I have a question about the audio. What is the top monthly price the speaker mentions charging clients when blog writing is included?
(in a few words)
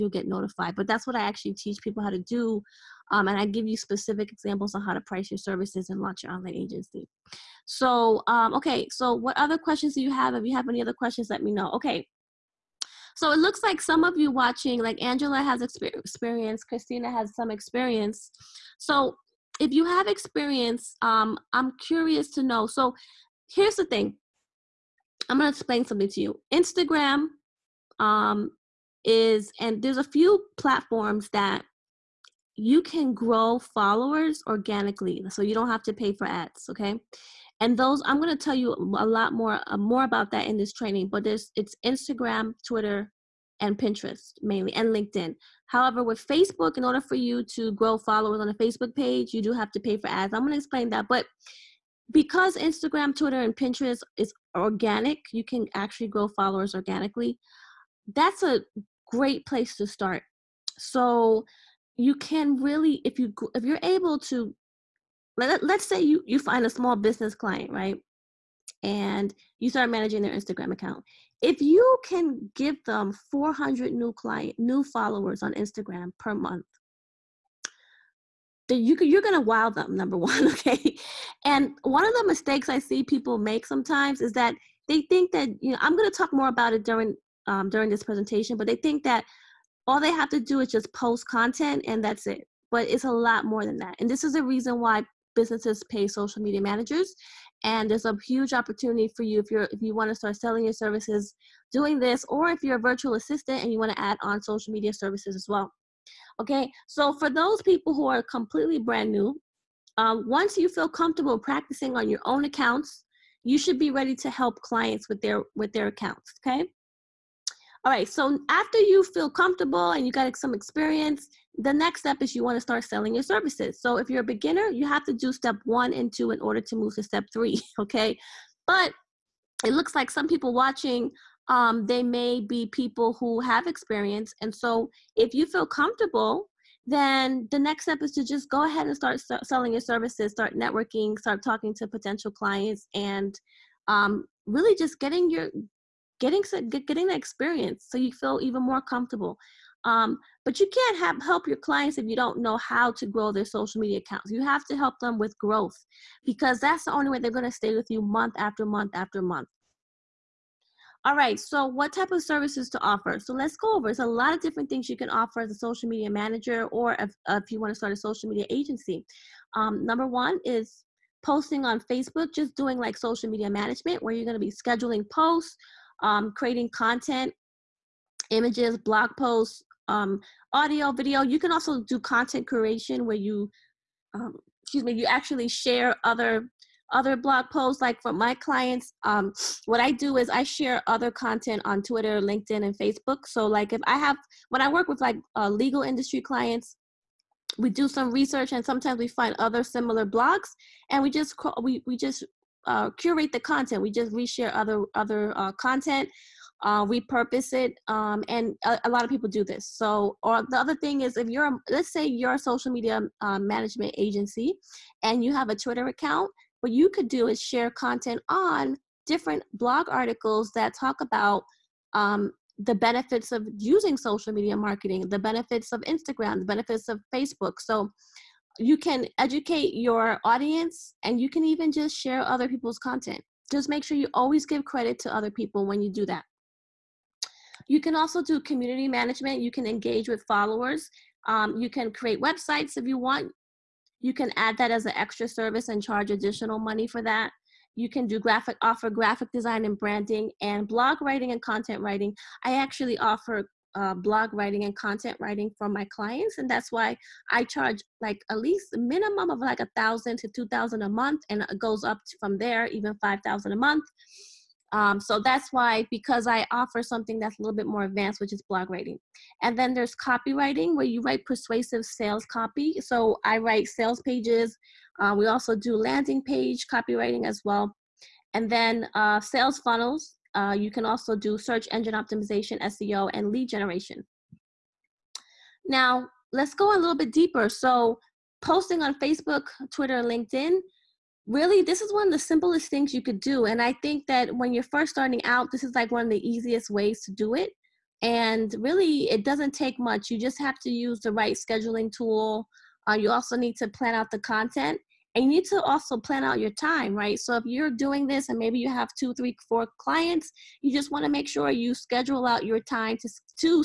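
$5,000.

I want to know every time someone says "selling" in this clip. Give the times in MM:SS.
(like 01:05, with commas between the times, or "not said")
01:40, 02:02, 02:19.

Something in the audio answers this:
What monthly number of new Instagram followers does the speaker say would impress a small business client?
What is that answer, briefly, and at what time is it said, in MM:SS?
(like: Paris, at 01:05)
400, at 01:13.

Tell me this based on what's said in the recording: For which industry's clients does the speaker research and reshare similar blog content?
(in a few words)
Legal industry.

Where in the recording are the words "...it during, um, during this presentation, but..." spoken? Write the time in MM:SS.
01:26.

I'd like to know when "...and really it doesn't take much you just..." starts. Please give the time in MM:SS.
04:58.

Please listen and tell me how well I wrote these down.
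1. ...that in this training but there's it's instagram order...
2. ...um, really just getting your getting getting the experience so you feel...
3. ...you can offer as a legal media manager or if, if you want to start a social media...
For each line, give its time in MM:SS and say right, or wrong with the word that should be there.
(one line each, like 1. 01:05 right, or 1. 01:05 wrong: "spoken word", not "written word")
1. 00:40 wrong: "twitter", not "order"
2. 02:23 right
3. 02:44 wrong: "social", not "legal".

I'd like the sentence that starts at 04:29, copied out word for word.
And then there's copywriting, where you write persuasive sales copy.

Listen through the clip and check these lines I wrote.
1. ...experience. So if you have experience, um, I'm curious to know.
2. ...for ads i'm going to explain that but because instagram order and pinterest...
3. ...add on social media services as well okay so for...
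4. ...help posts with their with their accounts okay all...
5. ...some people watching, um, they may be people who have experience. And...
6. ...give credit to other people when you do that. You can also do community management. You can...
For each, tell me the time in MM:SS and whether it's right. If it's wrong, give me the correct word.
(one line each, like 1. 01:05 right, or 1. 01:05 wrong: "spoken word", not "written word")
1. 00:17 right
2. 00:49 wrong: "twitter", not "order"
3. 01:43 right
4. 01:54 wrong: "clients", not "posts"
5. 02:10 right
6. 03:54 right.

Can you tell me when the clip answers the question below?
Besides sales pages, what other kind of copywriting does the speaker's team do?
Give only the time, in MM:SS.
04:35.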